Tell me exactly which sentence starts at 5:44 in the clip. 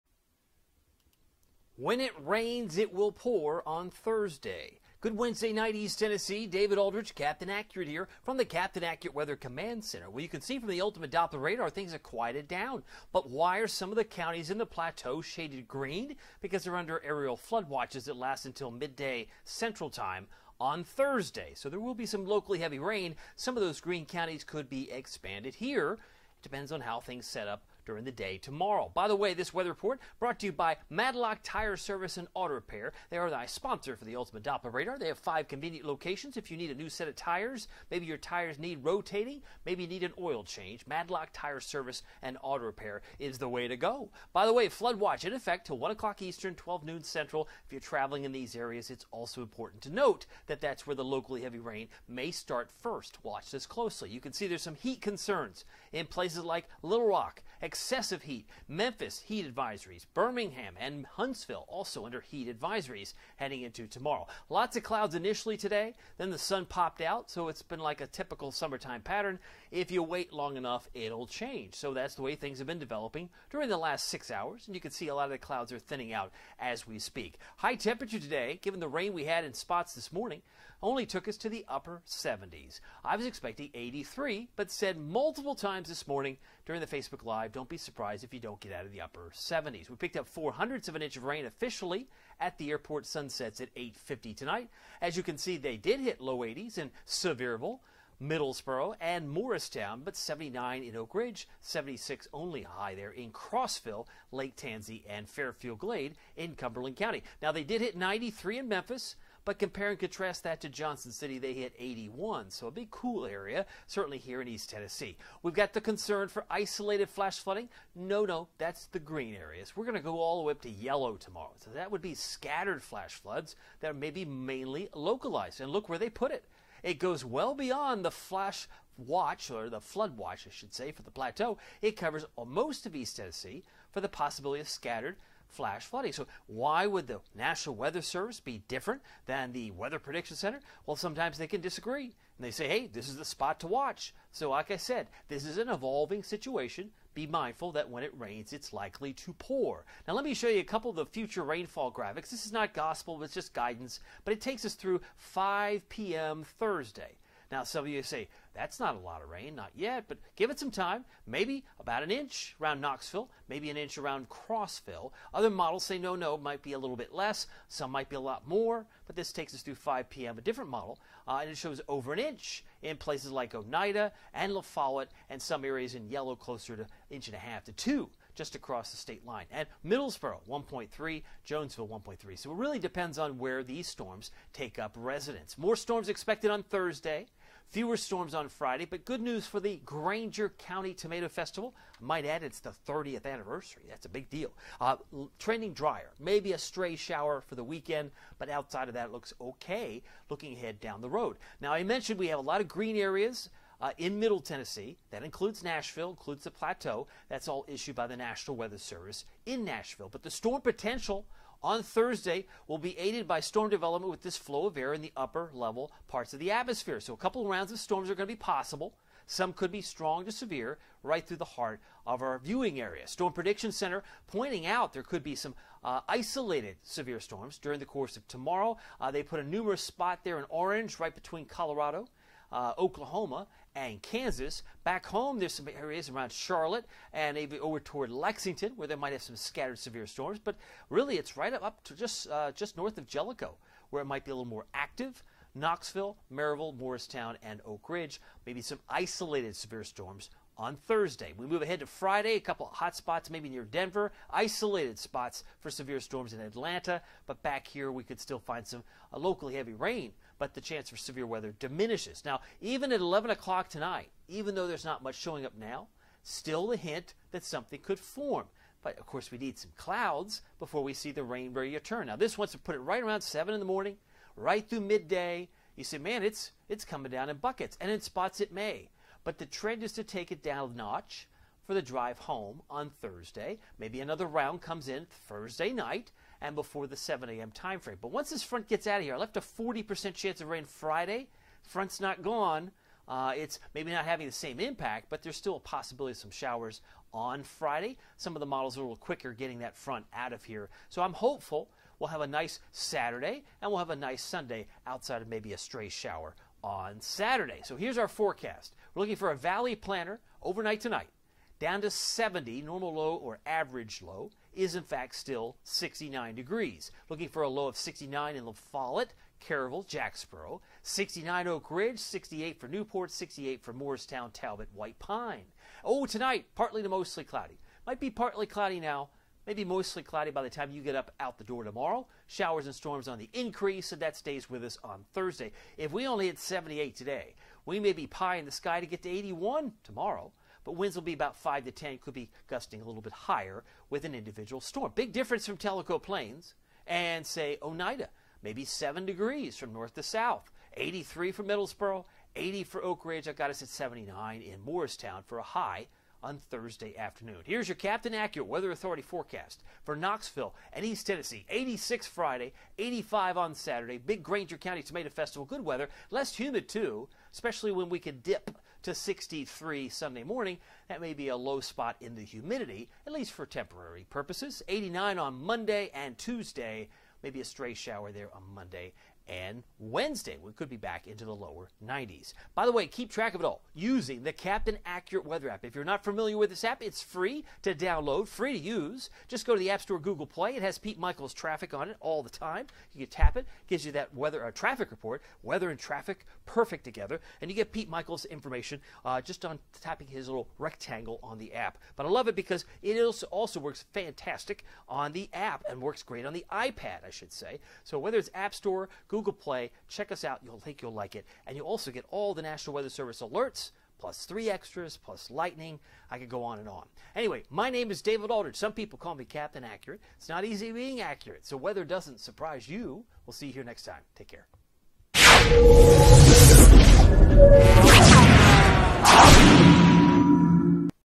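Big difference from Tellico Plains and, say, Oneida, maybe 7 degrees from north to south, 83 for Middlesboro, 80 for Oak Ridge.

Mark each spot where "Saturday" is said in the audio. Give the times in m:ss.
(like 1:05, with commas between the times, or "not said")
5:02, 5:07, 6:03.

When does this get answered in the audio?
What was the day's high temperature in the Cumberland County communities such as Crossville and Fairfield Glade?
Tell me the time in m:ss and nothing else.
1:41.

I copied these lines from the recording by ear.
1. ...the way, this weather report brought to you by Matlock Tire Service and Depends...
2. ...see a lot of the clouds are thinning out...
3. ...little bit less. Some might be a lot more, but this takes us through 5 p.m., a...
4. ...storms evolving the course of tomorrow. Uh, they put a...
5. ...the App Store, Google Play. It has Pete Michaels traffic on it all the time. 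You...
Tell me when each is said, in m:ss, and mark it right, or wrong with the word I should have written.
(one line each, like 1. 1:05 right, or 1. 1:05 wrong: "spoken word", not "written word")
1. 0:29 wrong: "Auto", not "Depends"
2. 1:14 right
3. 2:46 right
4. 3:47 wrong: "during", not "evolving"
5. 6:29 right.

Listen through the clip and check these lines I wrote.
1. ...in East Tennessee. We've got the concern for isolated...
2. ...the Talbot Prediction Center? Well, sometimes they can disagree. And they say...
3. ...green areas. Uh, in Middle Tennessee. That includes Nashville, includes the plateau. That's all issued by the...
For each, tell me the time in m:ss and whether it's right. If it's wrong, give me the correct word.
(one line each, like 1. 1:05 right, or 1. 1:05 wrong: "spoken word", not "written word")
1. 1:54 right
2. 2:19 wrong: "Weather", not "Talbot"
3. 3:22 right.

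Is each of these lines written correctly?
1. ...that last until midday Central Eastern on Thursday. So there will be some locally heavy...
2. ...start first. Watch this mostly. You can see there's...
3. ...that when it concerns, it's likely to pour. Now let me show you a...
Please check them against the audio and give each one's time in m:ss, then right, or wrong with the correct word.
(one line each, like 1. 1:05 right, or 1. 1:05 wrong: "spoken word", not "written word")
1. 0:18 wrong: "Time", not "Eastern"
2. 0:52 wrong: "closely", not "mostly"
3. 2:27 wrong: "rains", not "concerns".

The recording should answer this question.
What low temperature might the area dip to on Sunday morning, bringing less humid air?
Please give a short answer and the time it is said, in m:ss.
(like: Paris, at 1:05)
63, at 6:08.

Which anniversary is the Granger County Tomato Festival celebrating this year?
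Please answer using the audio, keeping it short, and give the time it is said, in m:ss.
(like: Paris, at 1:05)
30th, at 3:12.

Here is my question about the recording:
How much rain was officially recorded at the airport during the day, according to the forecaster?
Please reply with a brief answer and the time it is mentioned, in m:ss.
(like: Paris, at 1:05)
0.04 inch, at 1:30.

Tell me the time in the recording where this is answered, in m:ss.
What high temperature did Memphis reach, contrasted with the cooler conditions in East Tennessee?
1:47.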